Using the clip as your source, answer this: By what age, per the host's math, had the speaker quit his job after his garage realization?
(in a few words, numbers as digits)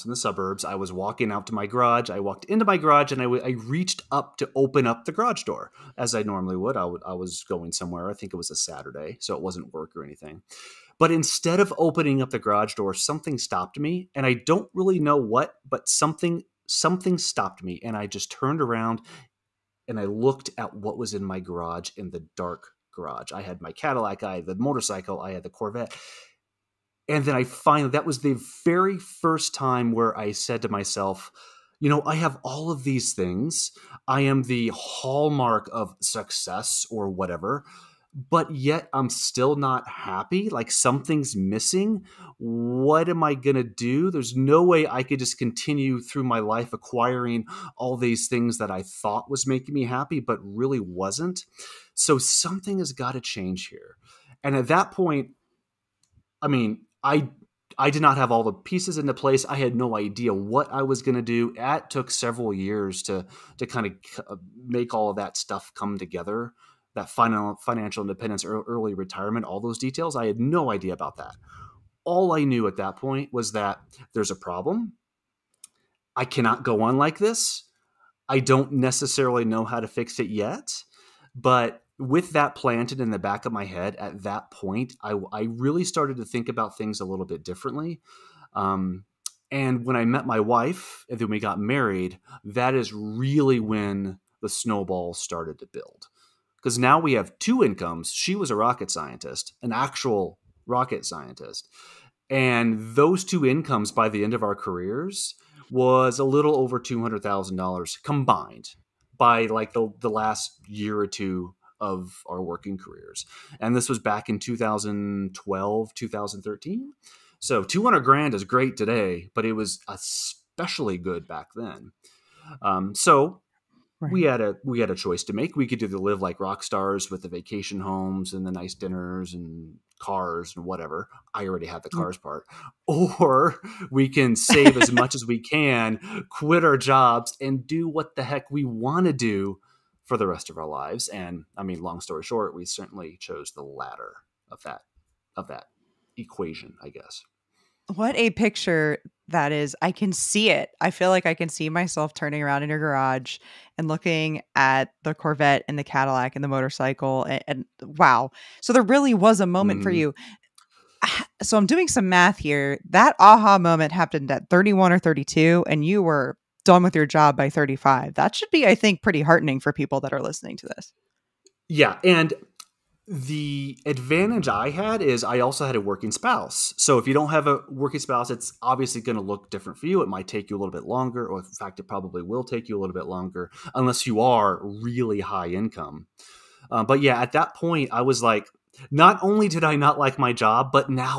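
35.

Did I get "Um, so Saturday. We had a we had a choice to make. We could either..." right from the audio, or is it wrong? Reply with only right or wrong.
wrong.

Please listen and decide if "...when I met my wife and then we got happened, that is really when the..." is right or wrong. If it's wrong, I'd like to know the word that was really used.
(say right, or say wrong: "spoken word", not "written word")
wrong: "married", not "happened".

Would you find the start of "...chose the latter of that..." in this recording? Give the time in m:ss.
2:23.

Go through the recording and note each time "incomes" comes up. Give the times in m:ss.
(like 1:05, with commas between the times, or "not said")
1:37, 1:43, 3:05.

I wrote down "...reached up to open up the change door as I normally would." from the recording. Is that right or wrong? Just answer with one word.
wrong.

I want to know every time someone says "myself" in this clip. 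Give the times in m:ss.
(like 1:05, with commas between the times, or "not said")
0:30, 2:31.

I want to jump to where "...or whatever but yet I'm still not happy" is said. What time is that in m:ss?
0:36.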